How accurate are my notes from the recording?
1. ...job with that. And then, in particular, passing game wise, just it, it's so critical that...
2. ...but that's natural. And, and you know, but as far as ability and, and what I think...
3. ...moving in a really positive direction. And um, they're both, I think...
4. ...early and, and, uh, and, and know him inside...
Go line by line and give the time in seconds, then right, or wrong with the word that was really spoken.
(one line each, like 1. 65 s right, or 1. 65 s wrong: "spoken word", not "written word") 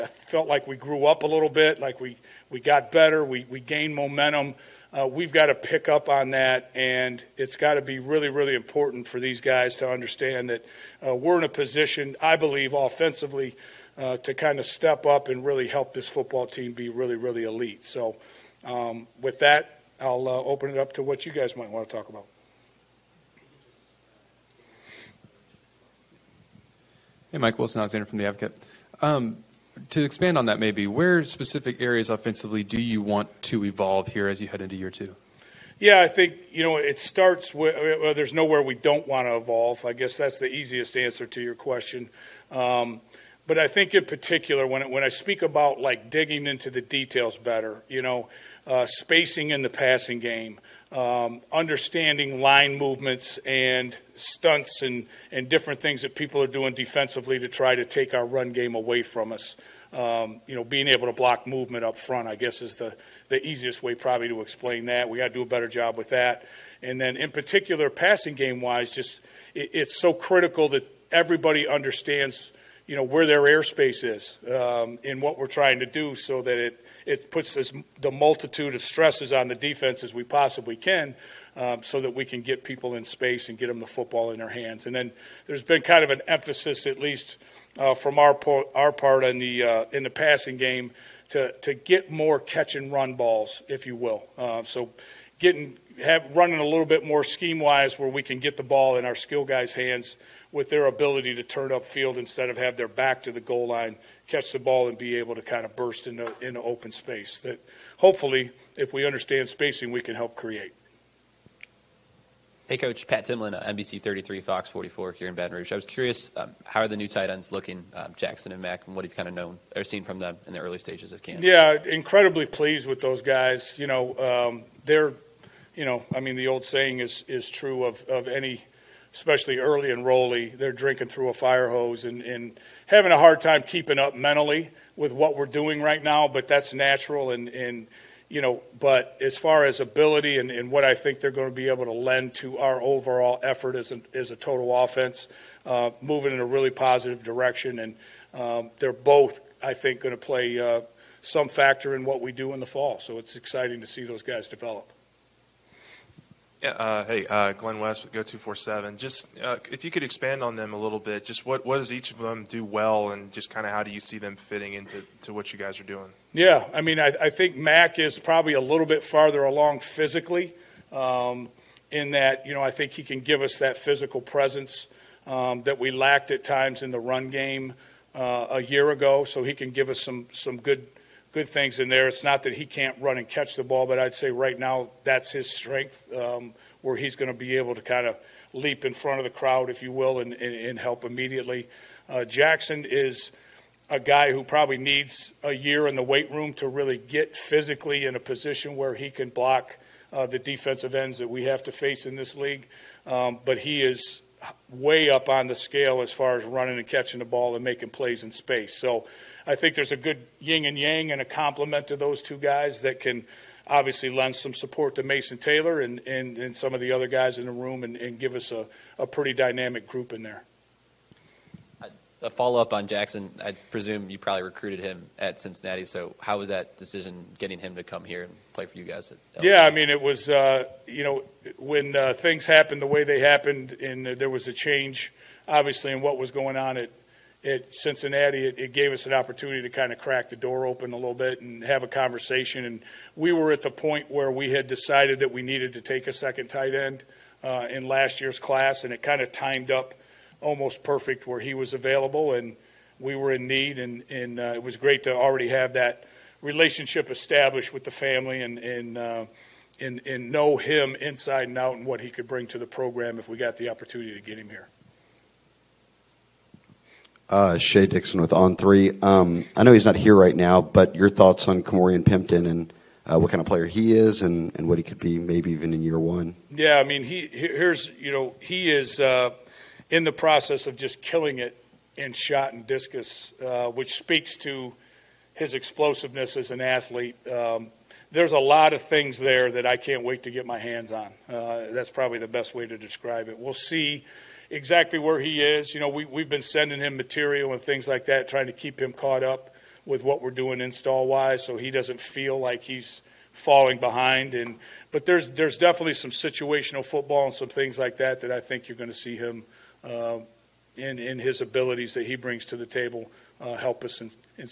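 1. 65 s right
2. 136 s right
3. 146 s right
4. 257 s wrong: "family", not "early".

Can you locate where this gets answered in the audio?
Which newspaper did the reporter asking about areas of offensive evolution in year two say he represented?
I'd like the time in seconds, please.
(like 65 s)
28 s.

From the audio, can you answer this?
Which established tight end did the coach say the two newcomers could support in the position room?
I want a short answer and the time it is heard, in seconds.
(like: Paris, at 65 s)
Mason Taylor, at 215 s.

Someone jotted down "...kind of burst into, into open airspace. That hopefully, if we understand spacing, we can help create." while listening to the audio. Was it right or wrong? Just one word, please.
wrong.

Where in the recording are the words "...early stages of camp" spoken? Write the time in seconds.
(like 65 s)
120 s.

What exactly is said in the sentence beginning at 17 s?
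So, um, with that, I'll uh, open it up to what you guys might want to talk about.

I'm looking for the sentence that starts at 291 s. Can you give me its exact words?
Uh, that's probably the best way to describe it.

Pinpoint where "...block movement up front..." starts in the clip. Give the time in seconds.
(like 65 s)
61 s.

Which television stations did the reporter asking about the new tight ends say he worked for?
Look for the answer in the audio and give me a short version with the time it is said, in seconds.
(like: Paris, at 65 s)
NBC 33, Fox 44, at 113 s.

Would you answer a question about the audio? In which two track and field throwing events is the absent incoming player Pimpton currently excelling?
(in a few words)
Shot and discus.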